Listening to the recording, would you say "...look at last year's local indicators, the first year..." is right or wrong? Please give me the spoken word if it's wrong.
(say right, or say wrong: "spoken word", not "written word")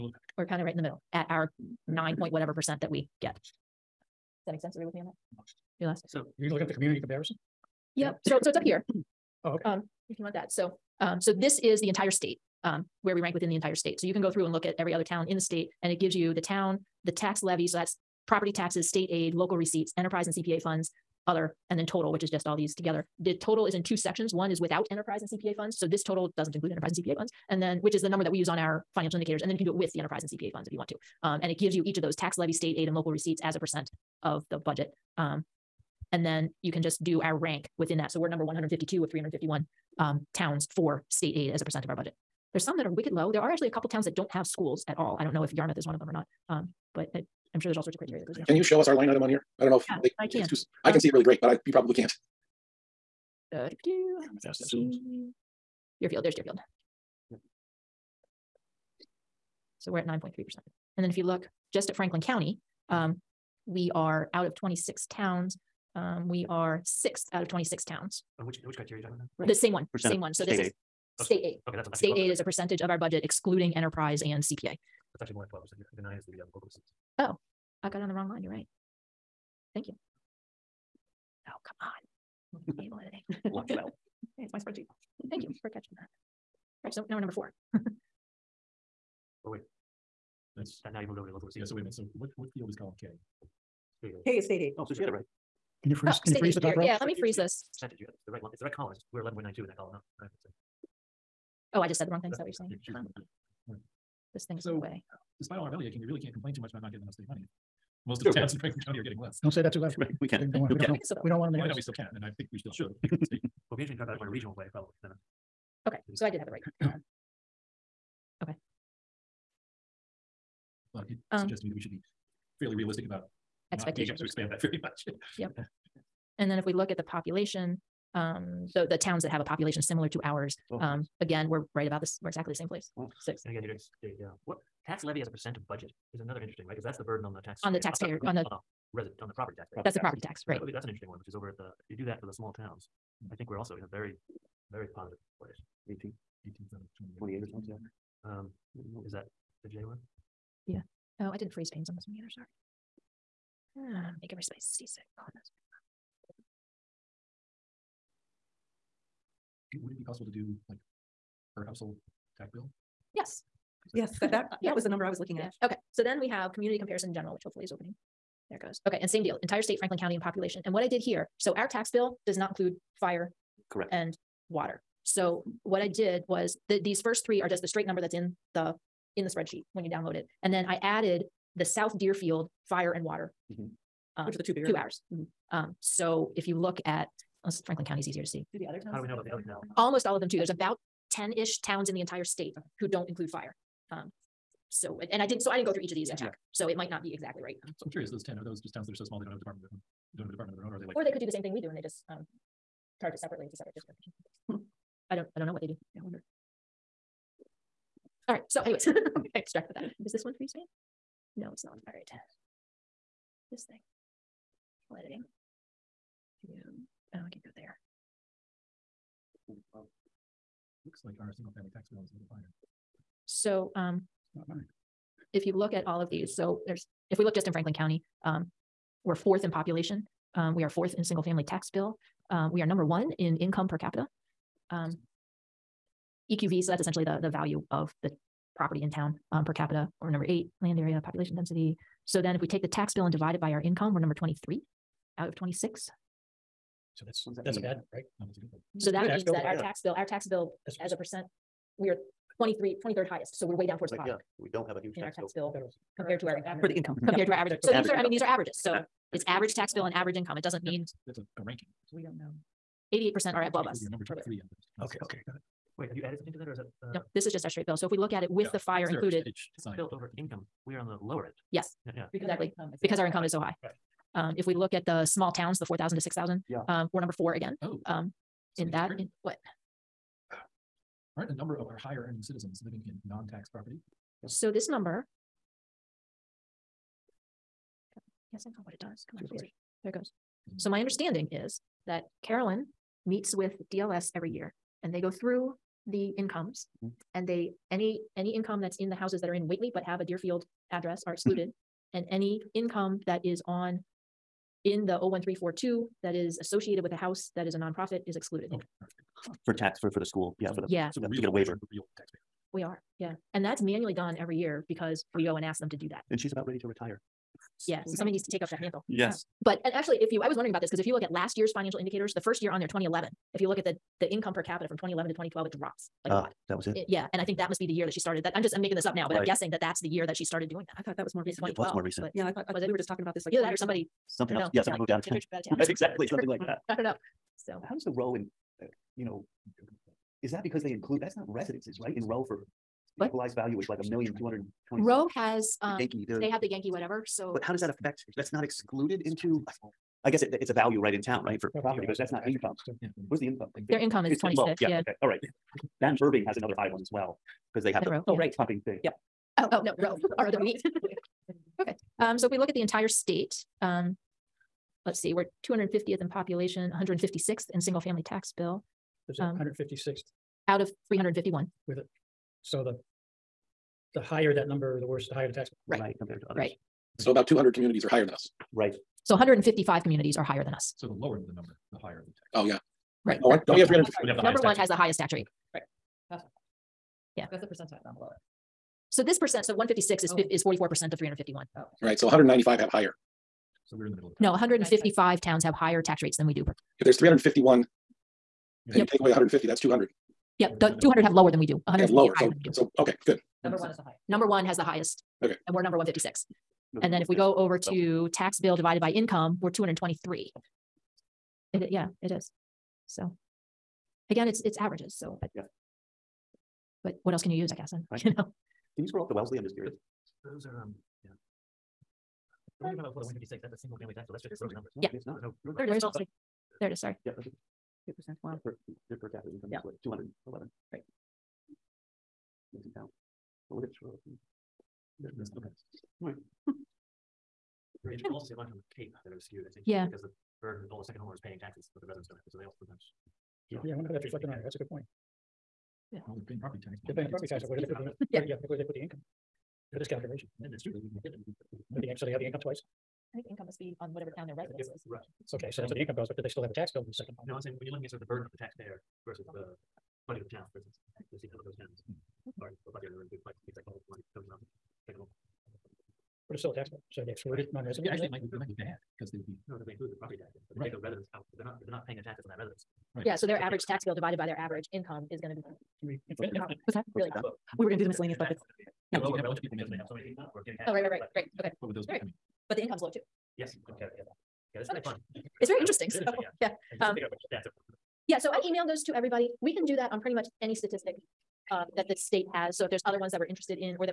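wrong: "financial", not "local".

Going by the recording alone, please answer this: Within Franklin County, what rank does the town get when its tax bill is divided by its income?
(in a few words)
23.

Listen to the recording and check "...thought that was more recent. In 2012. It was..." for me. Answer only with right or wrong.
right.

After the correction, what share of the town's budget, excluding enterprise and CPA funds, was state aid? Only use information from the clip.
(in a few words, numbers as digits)
11.92.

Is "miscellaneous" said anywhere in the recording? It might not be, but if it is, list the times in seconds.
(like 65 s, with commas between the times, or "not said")
477 s.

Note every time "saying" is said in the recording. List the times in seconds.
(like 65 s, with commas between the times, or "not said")
102 s, 457 s.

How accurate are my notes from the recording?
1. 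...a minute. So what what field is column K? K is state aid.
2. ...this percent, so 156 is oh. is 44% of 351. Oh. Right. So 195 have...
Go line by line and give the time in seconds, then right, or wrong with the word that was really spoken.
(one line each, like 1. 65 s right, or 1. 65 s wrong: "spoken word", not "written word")
1. 91 s right
2. 389 s right.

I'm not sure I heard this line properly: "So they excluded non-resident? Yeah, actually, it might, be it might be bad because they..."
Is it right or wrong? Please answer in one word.
right.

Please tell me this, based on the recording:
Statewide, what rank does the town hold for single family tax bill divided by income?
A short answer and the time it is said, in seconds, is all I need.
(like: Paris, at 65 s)
223, at 409 s.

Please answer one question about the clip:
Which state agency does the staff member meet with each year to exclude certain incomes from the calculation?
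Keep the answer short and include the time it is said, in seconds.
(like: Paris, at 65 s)
DLS, at 293 s.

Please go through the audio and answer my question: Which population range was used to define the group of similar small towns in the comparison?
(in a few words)
4,000 to 6,000.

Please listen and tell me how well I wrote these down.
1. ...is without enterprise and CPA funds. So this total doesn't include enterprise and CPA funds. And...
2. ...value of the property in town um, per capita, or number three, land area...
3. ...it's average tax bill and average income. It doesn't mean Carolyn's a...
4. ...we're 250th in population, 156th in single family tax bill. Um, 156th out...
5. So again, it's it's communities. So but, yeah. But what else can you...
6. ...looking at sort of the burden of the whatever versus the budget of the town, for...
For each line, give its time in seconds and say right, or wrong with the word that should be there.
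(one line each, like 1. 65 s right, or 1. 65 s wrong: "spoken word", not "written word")
1. 24 s right
2. 237 s wrong: "eight", not "three"
3. 259 s wrong: "That", not "Carolyn"
4. 365 s right
5. 412 s wrong: "averages", not "communities"
6. 457 s wrong: "taxpayer", not "whatever".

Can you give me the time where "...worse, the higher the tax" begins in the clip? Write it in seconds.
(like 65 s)
374 s.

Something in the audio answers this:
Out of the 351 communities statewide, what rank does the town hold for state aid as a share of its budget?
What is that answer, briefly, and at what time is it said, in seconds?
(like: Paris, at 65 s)
152, at 38 s.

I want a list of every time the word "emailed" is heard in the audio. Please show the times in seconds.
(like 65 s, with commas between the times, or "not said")
488 s.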